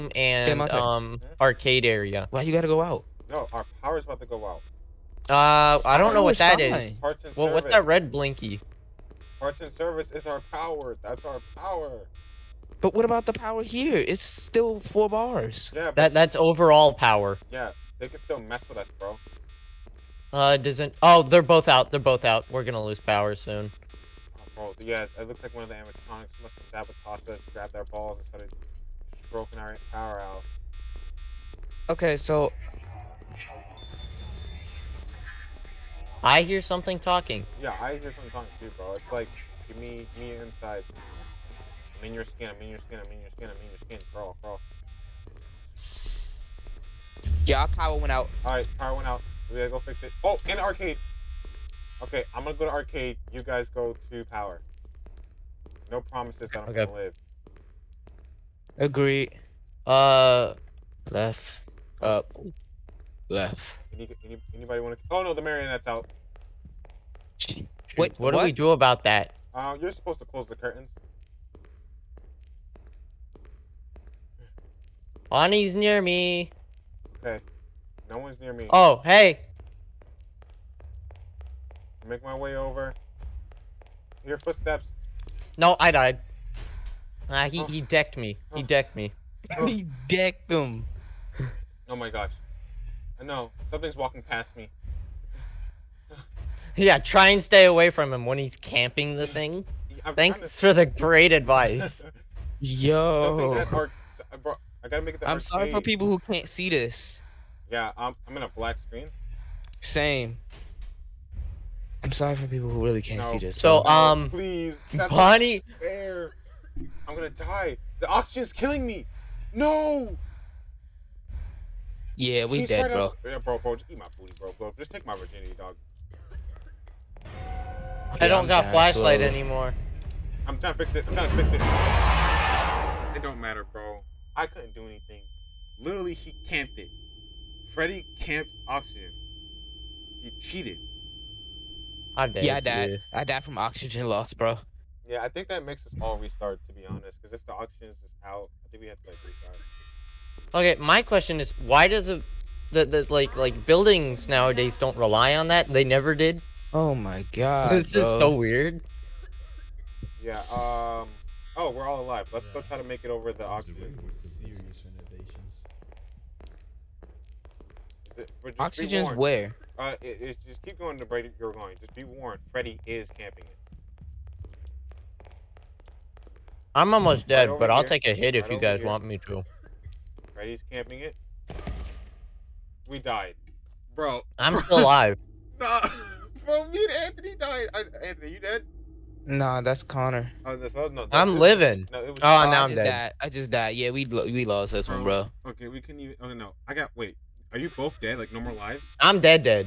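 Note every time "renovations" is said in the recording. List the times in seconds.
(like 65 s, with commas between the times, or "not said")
168 s.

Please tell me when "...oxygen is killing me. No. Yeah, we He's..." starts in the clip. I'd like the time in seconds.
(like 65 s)
118 s.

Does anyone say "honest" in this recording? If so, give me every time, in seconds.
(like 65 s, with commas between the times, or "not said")
146 s.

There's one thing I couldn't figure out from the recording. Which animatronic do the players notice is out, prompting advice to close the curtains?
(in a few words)
The Marionette.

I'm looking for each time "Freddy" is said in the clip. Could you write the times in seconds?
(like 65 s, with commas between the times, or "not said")
137 s, 172 s, 180 s.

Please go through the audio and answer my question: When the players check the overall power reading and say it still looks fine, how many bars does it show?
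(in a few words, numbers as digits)
4.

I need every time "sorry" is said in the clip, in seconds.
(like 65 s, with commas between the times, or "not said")
105 s, 112 s.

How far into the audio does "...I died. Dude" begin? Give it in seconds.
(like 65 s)
142 s.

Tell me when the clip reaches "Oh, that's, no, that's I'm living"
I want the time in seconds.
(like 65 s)
190 s.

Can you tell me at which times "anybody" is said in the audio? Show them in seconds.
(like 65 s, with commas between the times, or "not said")
64 s.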